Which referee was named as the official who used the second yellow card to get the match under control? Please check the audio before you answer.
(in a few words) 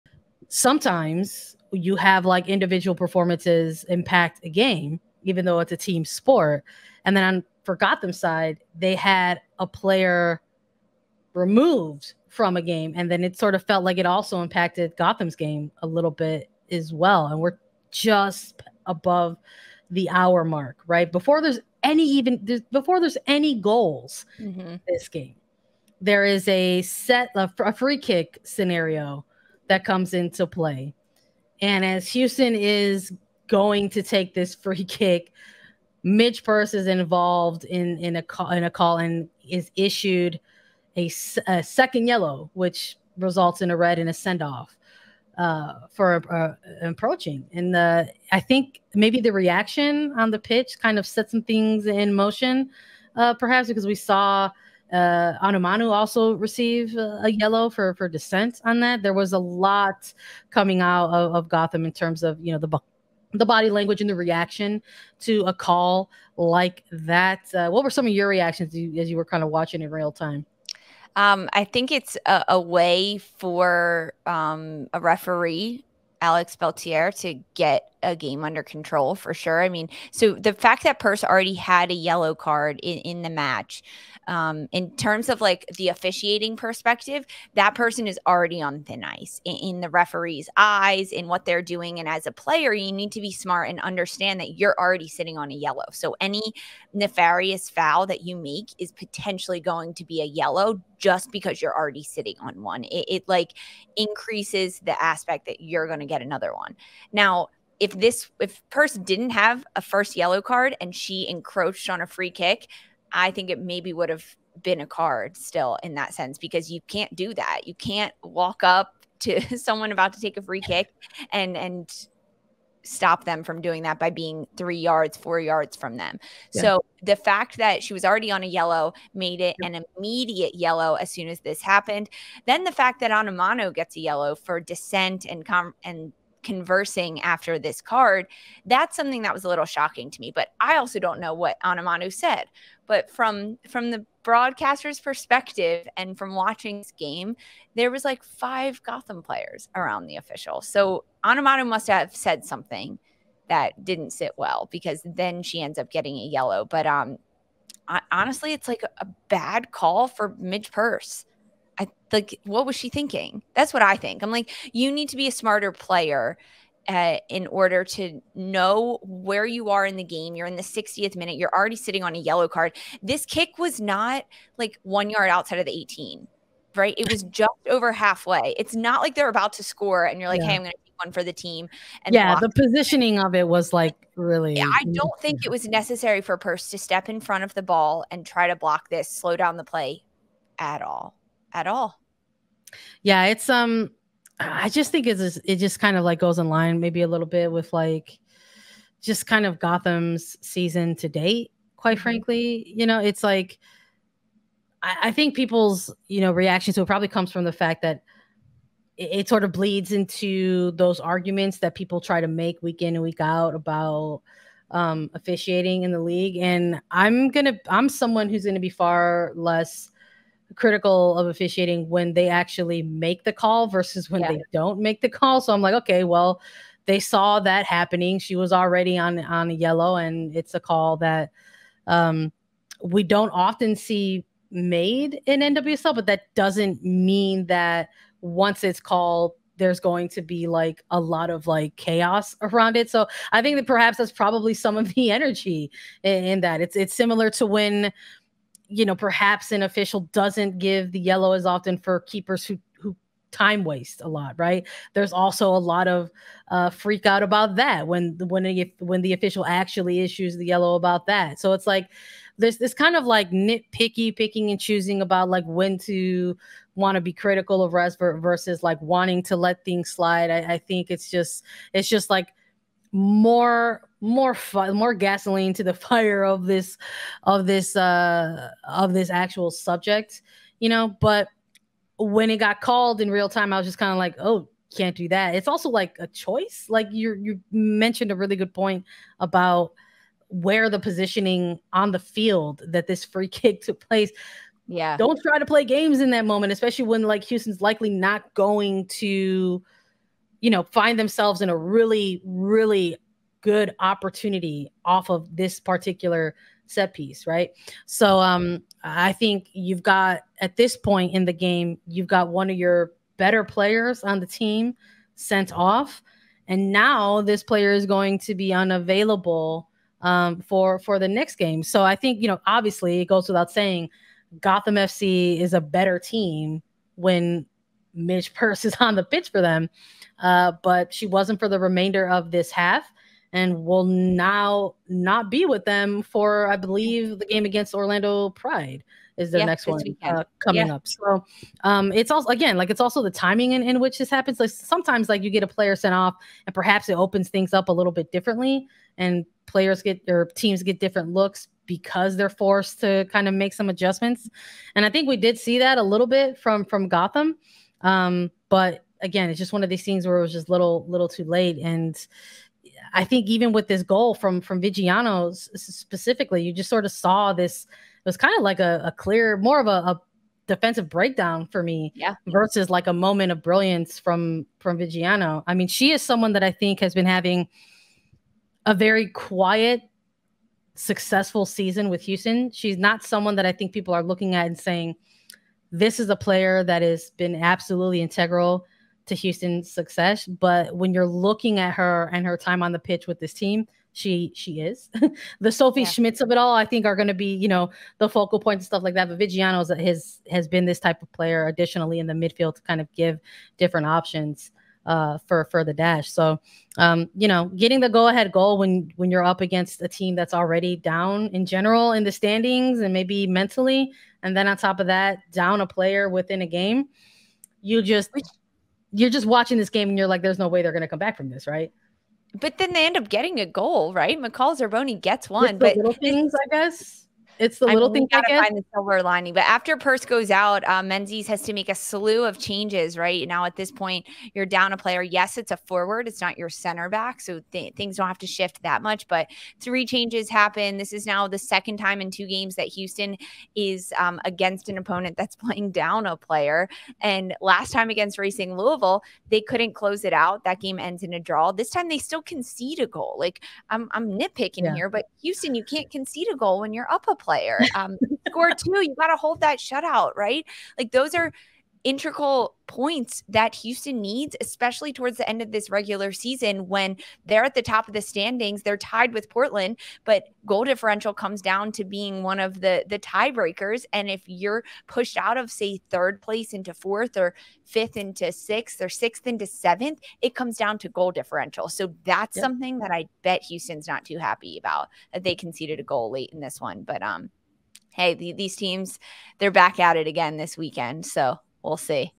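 Alex Beltier.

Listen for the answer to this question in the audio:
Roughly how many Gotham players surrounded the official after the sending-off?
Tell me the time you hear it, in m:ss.
2:28.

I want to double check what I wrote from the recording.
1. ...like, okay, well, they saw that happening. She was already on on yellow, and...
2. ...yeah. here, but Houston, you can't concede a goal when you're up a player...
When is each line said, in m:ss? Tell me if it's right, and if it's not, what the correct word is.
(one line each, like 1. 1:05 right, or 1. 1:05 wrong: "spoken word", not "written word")
1. 3:45 right
2. 7:34 right.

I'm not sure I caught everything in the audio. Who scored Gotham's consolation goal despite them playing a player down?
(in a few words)
McCall Zerboni.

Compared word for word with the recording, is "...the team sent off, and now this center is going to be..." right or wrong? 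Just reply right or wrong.
wrong.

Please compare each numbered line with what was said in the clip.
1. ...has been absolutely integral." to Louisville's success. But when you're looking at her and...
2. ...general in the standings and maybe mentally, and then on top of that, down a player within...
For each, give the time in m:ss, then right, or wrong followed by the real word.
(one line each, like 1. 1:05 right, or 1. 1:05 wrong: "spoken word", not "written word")
1. 6:26 wrong: "Houston", not "Louisville"
2. 6:51 right.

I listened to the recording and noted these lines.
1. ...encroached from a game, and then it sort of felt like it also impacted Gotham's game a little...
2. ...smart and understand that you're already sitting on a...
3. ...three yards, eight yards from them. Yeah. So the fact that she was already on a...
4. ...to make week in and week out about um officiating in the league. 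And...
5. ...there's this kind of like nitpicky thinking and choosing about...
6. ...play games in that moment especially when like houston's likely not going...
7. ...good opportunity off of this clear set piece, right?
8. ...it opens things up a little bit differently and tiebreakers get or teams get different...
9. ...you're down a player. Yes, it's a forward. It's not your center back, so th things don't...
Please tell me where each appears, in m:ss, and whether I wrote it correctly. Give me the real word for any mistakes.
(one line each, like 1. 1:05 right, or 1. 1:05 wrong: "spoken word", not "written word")
1. 0:11 wrong: "removed", not "encroached"
2. 1:33 right
3. 2:04 wrong: "four", not "eight"
4. 3:32 right
5. 4:22 wrong: "picking", not "thinking"
6. 4:55 right
7. 5:03 wrong: "particular", not "clear"
8. 5:46 wrong: "players", not "tiebreakers"
9. 7:14 right.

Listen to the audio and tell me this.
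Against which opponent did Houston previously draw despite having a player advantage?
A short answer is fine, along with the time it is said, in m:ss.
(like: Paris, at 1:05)
Racing Louisville, at 7:28.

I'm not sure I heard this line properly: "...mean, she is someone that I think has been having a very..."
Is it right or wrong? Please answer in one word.
right.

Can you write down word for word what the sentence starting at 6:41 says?
Additionally, in the midfield to kind of give different options uh, for for the dash.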